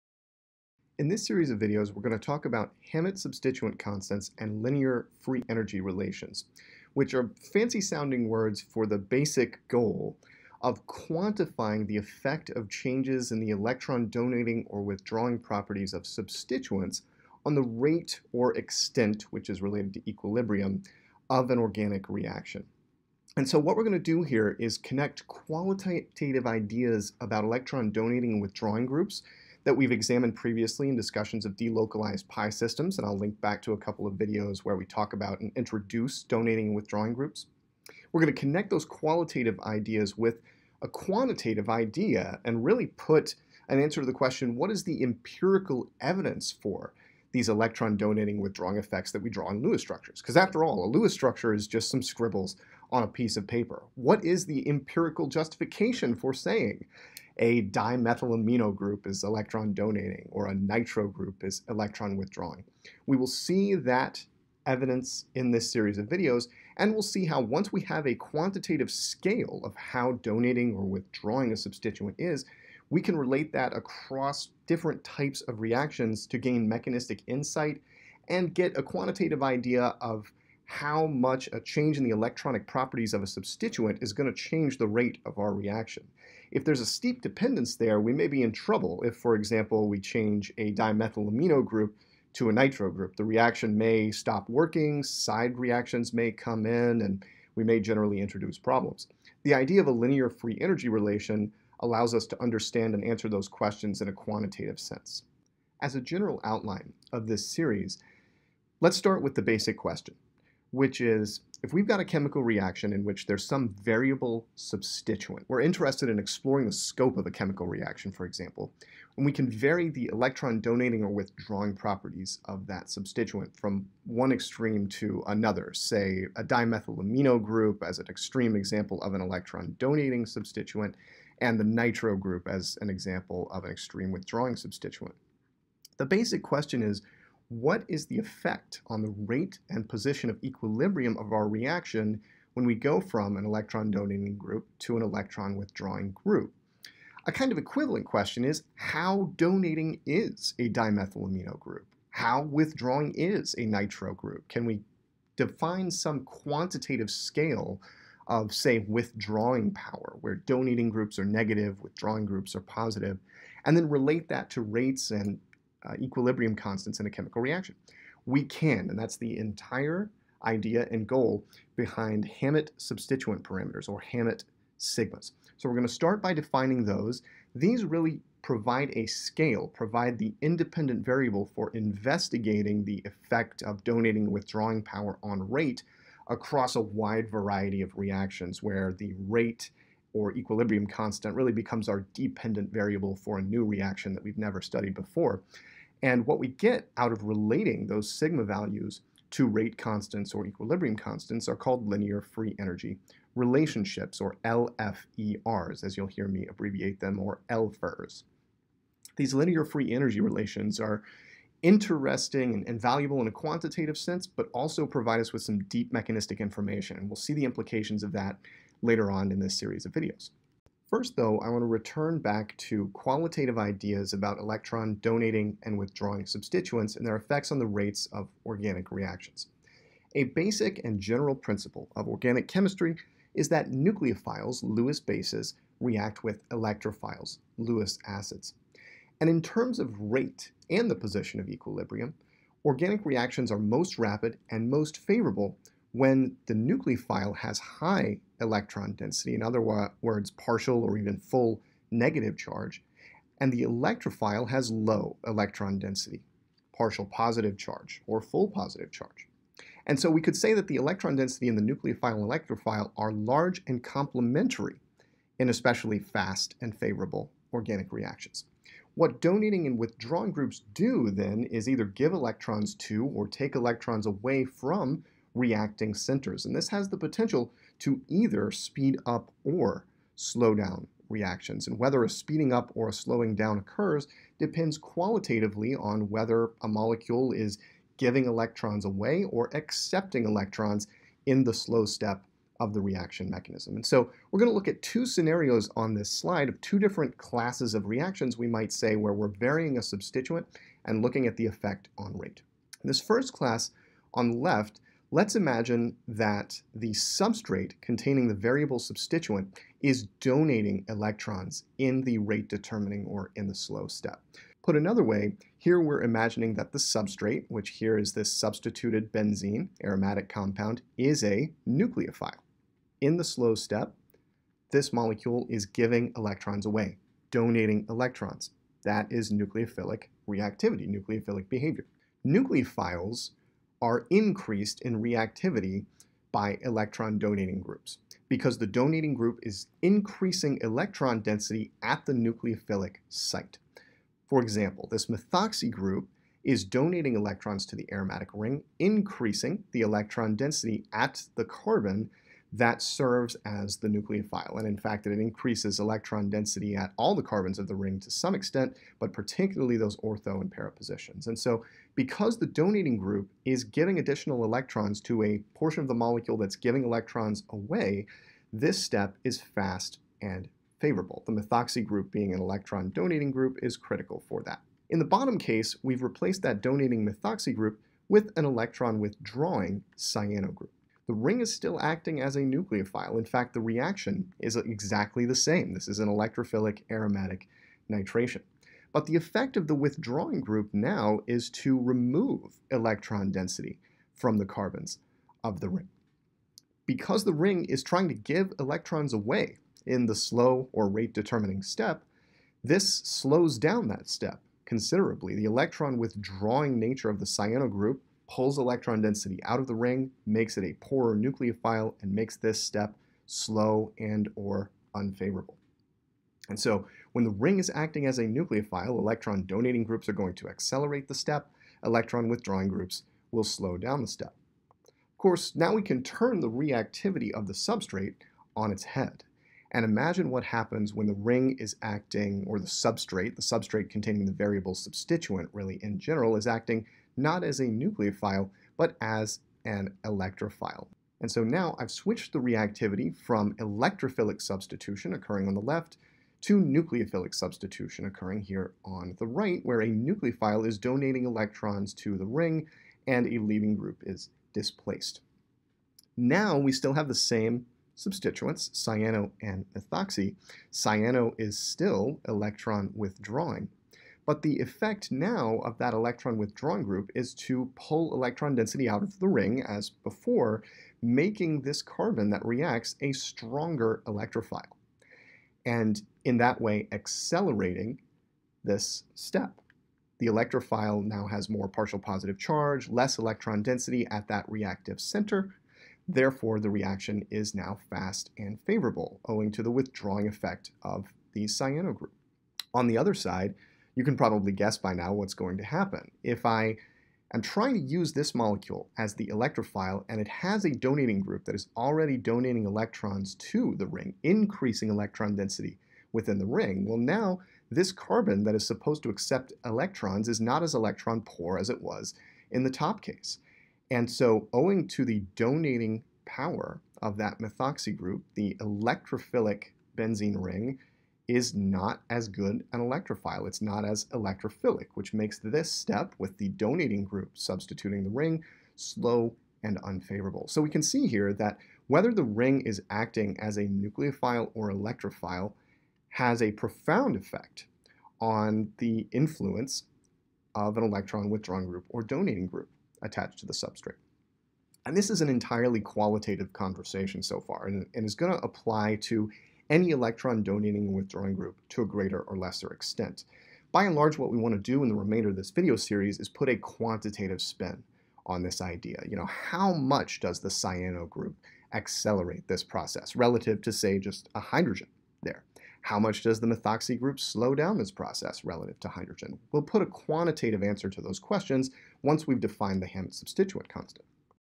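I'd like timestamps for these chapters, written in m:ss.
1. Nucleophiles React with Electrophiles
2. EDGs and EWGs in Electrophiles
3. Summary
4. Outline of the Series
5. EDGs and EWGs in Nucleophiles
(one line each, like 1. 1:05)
1. 3:40
2. 7:05
3. 8:50
4. 1:45
5. 5:02.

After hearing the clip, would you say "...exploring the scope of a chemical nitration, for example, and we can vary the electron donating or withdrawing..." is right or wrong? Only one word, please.
wrong.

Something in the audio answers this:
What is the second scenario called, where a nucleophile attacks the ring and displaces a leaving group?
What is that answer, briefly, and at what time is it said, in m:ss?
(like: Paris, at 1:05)
nucleophilic substitution, at 7:26.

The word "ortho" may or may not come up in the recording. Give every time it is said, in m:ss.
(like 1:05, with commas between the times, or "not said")
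5:59.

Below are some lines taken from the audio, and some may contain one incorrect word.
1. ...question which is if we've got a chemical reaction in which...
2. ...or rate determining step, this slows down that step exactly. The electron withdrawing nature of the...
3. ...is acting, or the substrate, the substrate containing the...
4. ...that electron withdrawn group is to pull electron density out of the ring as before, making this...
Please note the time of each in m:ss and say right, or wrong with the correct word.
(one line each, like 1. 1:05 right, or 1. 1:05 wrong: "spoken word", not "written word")
1. 1:49 right
2. 6:40 wrong: "considerably", not "exactly"
3. 7:11 right
4. 7:45 right.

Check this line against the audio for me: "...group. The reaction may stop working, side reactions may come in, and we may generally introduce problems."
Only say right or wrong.
right.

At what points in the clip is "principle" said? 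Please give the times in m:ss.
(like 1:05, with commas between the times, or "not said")
3:51.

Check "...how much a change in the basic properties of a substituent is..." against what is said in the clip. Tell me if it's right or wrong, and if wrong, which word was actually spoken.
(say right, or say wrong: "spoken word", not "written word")
wrong: "electronic", not "basic".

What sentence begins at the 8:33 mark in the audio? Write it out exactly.
And so owing to the donating power of that methoxy group, the electrophilic benzene ring is not as good an electrophile.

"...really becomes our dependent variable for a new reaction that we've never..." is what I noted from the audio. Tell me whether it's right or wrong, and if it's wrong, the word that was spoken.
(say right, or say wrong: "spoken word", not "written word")
right.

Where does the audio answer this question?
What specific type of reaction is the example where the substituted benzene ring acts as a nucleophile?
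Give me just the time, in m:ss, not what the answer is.
6:26.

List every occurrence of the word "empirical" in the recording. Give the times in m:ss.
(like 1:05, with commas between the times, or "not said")
0:45, 0:54.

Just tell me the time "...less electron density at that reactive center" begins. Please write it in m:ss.
8:02.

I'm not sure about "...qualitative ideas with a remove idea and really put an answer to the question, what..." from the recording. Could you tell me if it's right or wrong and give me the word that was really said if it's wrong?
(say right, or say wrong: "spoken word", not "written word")
wrong: "quantitative", not "remove".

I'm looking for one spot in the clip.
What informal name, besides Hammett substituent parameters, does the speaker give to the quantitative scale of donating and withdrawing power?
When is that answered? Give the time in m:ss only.
2:54.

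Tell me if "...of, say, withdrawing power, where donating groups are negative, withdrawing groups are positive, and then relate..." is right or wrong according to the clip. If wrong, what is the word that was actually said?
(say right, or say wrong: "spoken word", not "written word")
right.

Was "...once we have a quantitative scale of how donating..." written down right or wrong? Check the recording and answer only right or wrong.
right.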